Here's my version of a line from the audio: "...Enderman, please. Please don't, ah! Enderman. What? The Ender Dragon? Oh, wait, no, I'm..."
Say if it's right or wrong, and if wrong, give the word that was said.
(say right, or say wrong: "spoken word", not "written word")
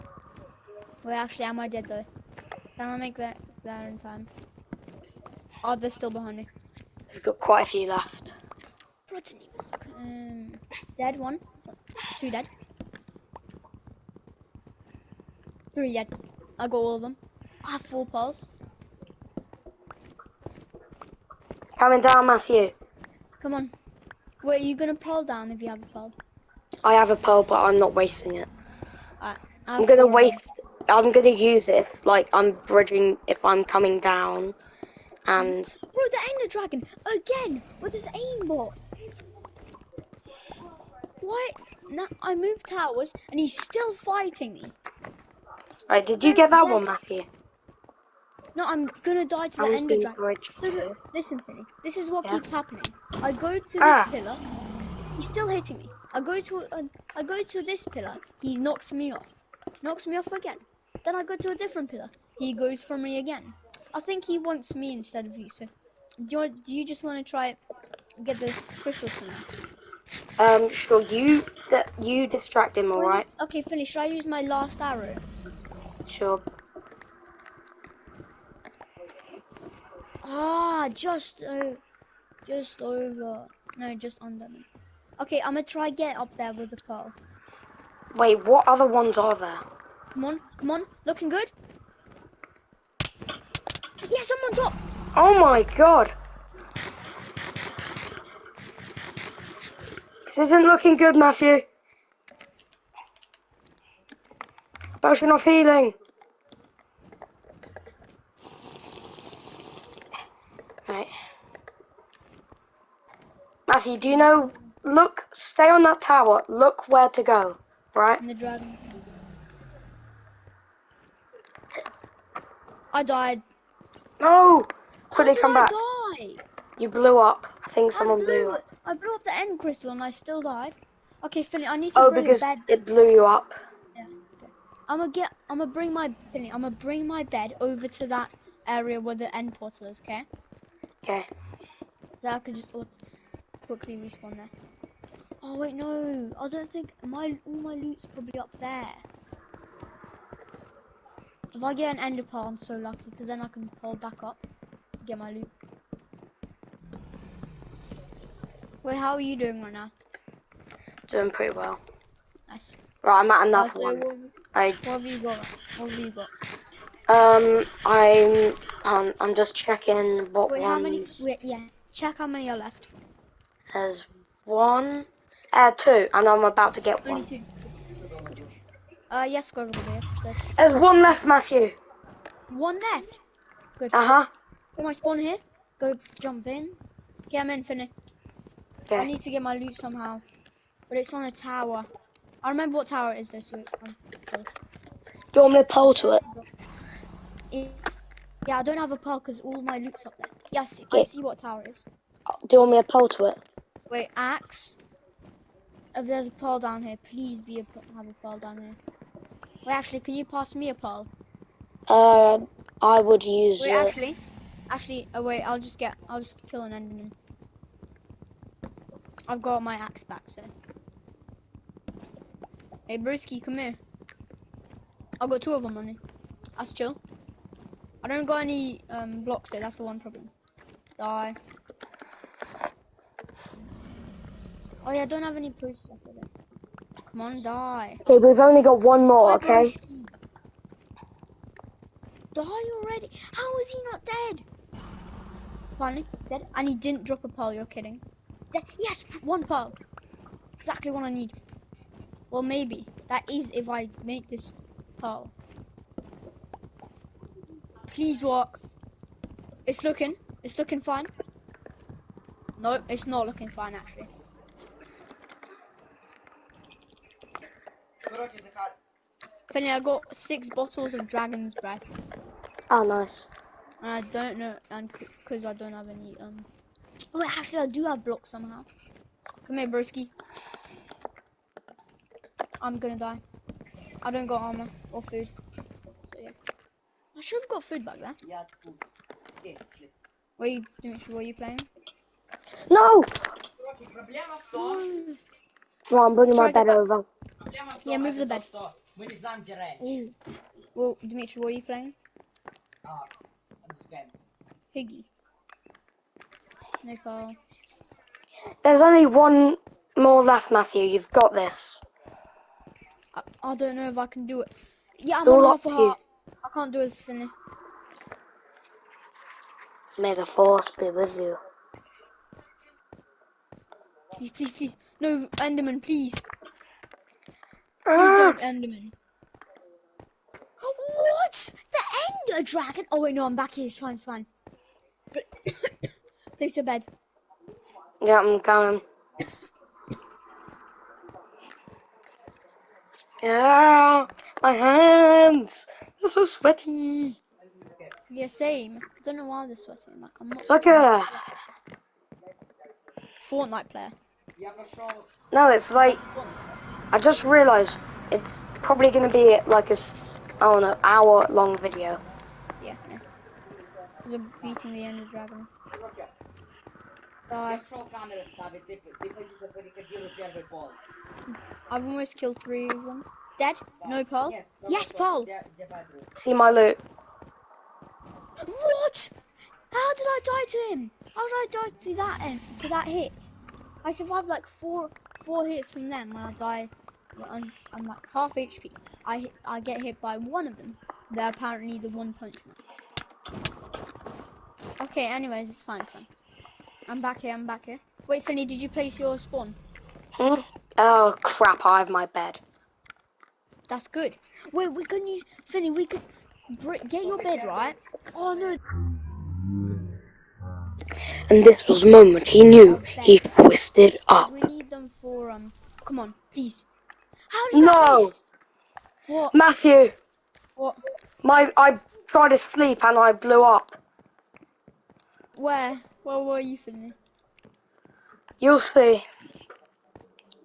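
right.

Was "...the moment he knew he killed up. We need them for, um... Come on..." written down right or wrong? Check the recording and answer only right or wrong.
wrong.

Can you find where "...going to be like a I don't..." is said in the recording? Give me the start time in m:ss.
5:58.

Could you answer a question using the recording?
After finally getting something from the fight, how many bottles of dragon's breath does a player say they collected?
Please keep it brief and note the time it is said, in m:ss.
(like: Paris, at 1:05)
6, at 4:30.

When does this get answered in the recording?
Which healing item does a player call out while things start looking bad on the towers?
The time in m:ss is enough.
1:45.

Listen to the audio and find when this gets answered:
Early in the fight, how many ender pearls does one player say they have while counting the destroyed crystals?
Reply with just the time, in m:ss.
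0:17.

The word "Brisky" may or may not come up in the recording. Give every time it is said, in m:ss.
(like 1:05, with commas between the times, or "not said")
3:42, 3:59.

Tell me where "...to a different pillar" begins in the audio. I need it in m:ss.
1:01.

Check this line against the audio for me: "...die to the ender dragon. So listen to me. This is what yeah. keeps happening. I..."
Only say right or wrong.
right.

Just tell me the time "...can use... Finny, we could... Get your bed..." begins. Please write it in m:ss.
6:44.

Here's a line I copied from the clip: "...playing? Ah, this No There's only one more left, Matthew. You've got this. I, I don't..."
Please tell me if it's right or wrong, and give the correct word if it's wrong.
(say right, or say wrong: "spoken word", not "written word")
right.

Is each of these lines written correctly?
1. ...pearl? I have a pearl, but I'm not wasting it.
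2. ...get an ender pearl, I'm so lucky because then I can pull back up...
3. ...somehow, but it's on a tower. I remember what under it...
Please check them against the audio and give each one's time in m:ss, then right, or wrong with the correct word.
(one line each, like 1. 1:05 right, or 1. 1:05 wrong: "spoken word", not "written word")
1. 0:25 right
2. 2:31 right
3. 3:09 wrong: "tower", not "under".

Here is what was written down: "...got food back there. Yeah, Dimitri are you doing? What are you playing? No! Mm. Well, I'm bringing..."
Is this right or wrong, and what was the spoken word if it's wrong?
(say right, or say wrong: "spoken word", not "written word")
wrong: "What", not "Dimitri".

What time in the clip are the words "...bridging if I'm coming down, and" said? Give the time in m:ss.
0:32.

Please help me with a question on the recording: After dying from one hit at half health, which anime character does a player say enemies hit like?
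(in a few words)
One Punch Man.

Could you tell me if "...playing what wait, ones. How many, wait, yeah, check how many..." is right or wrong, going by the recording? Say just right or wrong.
wrong.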